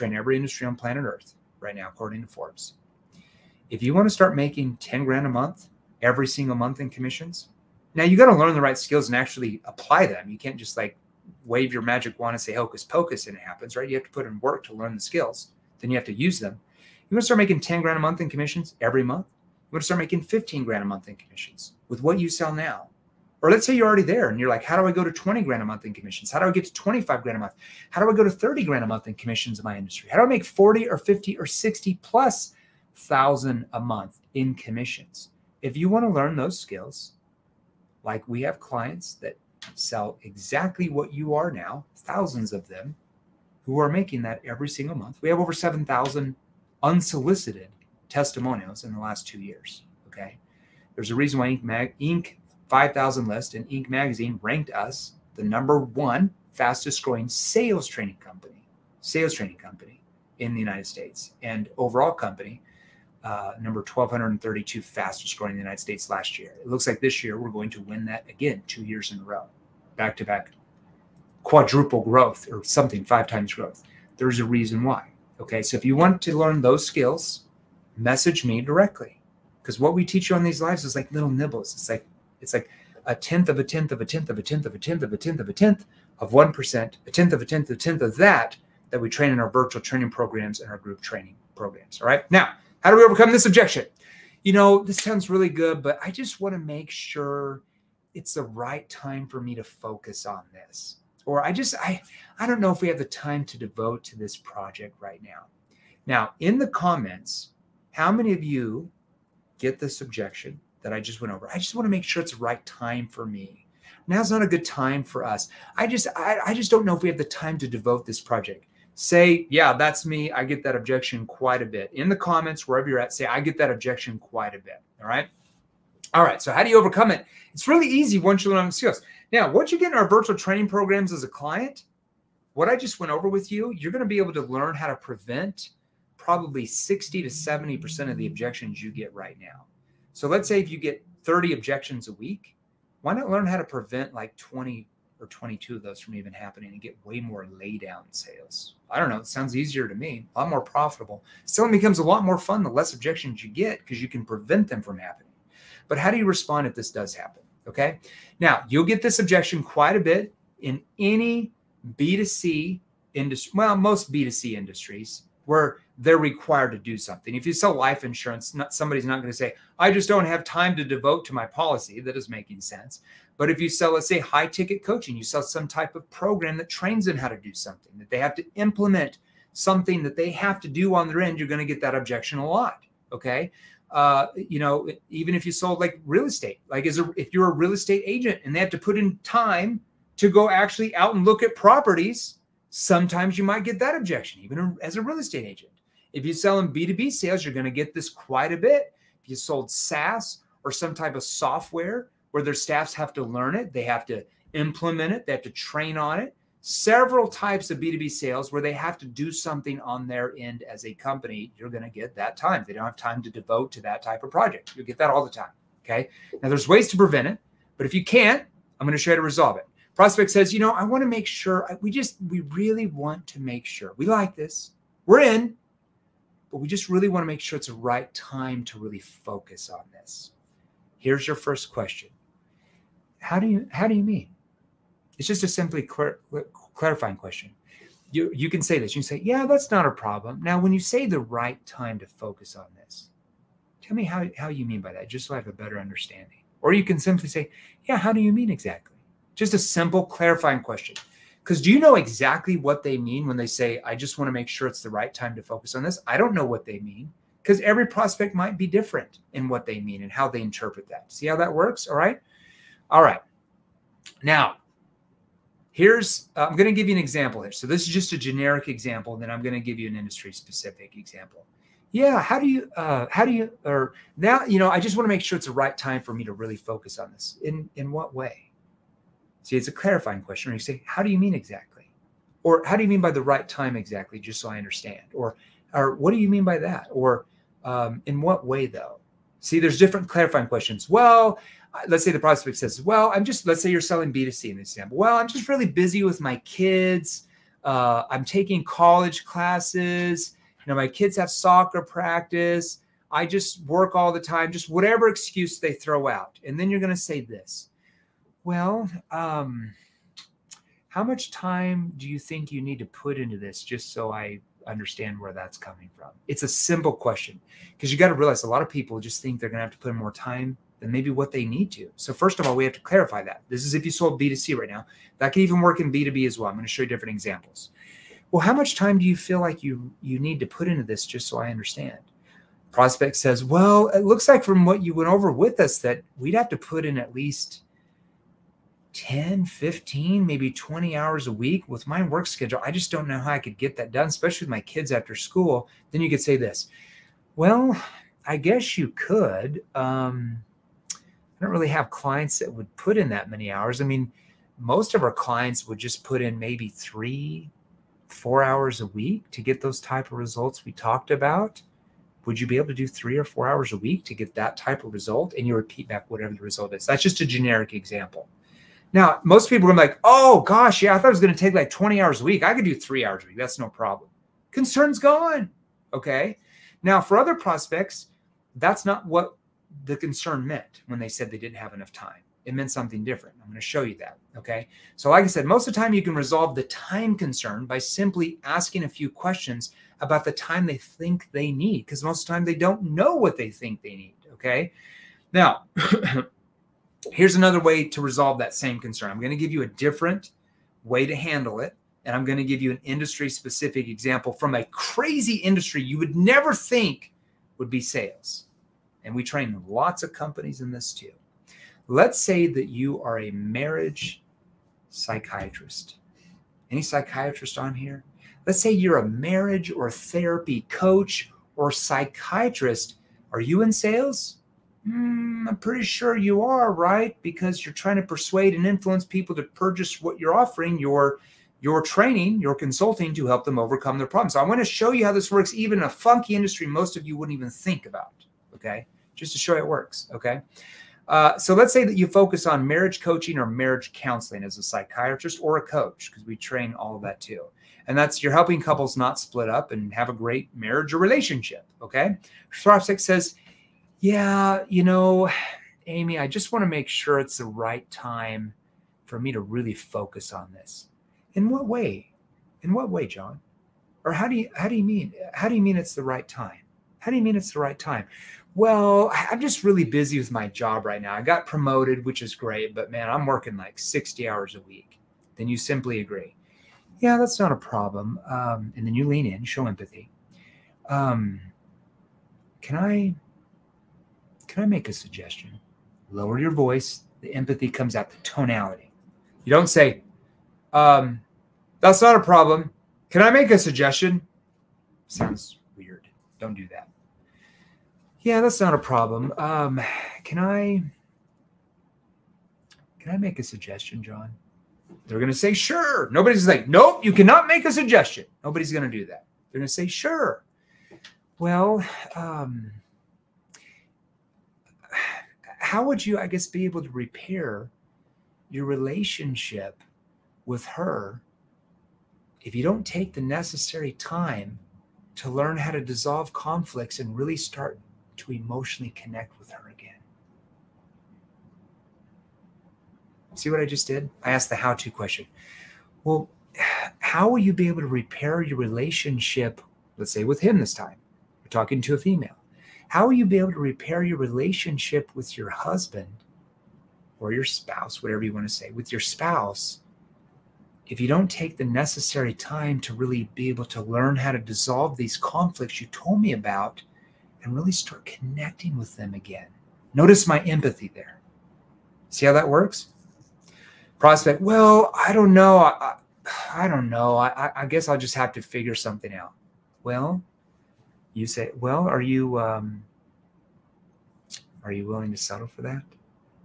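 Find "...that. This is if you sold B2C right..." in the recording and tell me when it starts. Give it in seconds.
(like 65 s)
323 s.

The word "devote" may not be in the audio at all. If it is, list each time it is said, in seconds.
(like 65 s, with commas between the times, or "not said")
103 s, 117 s, 170 s, 213 s.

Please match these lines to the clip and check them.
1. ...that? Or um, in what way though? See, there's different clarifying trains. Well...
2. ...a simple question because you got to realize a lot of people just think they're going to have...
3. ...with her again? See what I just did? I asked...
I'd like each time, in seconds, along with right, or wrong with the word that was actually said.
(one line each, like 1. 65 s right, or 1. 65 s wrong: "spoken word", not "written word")
1. 286 s wrong: "questions", not "trains"
2. 316 s right
3. 529 s right.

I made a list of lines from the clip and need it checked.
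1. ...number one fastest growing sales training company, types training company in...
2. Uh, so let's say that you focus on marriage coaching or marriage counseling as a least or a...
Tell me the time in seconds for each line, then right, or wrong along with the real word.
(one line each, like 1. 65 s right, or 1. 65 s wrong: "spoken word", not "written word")
1. 55 s wrong: "sales", not "types"
2. 441 s wrong: "psychiatrist", not "least".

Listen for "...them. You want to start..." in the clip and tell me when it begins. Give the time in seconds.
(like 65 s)
16 s.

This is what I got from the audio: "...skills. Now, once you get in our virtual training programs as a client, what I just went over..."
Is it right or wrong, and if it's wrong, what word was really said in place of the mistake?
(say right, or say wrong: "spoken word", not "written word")
right.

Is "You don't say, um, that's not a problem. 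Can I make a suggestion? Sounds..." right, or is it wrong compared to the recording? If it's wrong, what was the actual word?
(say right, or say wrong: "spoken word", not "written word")
right.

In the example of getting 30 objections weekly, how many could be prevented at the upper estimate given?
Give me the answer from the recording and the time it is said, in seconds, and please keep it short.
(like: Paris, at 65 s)
22, at 145 s.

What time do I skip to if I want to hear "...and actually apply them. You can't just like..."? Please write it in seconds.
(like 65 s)
9 s.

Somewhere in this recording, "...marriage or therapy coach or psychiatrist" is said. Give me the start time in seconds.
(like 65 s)
419 s.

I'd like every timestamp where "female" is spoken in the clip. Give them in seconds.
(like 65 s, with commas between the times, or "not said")
541 s.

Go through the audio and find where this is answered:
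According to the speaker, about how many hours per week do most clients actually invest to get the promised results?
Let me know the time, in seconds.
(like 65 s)
356 s.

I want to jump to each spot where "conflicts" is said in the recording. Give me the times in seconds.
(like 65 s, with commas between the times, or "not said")
526 s, 555 s.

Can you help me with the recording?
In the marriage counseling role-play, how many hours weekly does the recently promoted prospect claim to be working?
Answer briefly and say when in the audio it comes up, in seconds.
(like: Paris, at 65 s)
60, at 473 s.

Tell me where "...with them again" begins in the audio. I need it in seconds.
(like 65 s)
558 s.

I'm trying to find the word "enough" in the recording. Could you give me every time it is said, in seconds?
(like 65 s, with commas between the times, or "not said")
381 s.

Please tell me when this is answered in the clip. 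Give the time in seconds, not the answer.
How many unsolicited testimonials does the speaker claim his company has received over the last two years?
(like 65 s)
45 s.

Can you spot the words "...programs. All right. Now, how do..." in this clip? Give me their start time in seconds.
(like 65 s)
91 s.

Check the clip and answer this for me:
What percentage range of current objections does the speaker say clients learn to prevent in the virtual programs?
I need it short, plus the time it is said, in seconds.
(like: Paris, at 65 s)
60 to 70%, at 136 s.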